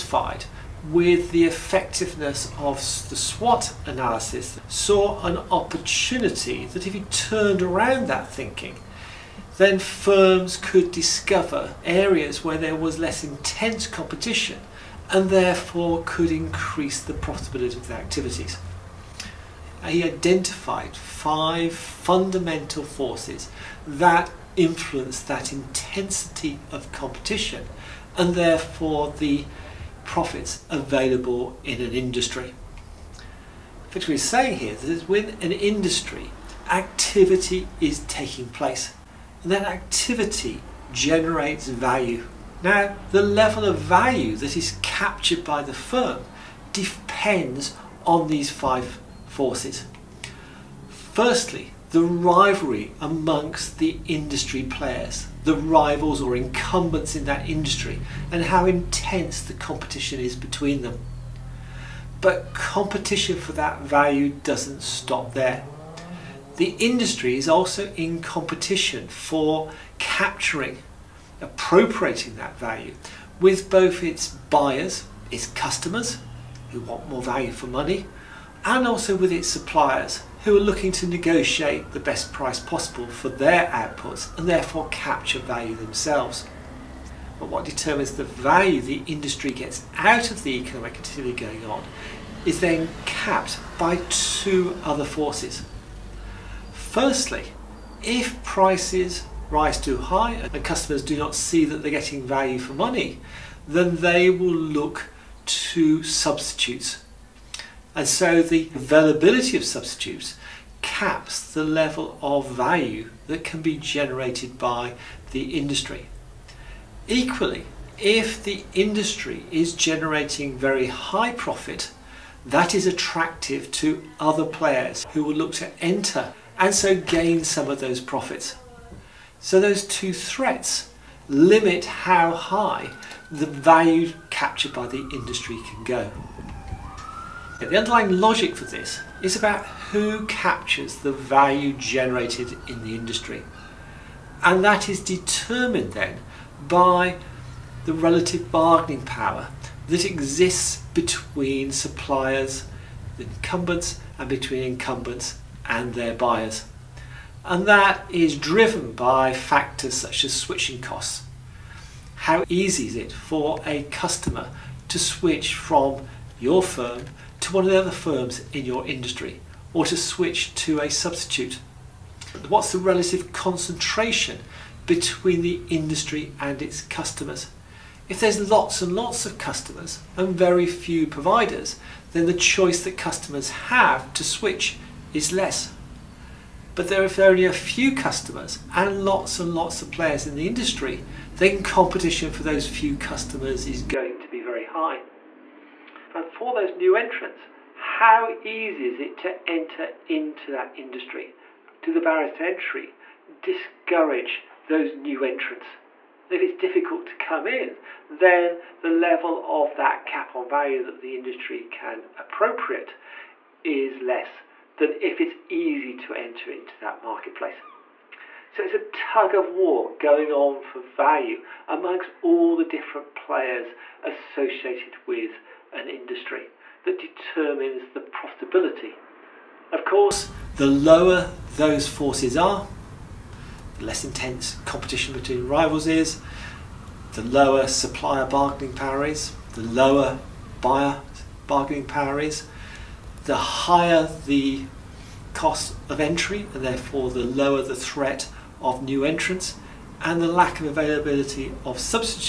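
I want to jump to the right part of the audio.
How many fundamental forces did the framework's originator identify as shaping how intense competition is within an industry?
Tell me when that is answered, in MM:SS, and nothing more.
00:20.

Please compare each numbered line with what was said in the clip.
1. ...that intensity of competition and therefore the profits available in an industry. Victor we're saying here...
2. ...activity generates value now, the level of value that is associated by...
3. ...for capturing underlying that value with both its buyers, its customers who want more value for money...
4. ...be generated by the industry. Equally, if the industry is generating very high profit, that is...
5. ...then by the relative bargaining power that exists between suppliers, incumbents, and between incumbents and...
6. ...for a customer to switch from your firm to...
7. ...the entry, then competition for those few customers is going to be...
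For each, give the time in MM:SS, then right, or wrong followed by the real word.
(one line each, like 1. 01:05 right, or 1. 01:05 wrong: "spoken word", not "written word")
1. 00:25 right
2. 00:39 wrong: "captured", not "associated"
3. 01:09 wrong: "appropriating", not "underlying"
4. 01:53 right
5. 02:25 right
6. 02:43 right
7. 03:10 wrong: "industry", not "entry".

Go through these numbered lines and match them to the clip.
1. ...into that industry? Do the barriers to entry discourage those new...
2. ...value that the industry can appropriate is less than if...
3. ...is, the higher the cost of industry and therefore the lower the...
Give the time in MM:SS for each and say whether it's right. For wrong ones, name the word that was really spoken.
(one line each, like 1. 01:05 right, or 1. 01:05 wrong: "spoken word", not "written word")
1. 03:20 right
2. 03:30 right
3. 04:02 wrong: "entry", not "industry".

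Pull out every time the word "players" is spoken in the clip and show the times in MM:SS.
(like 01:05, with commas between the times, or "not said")
00:54, 02:04, 03:09, 03:43.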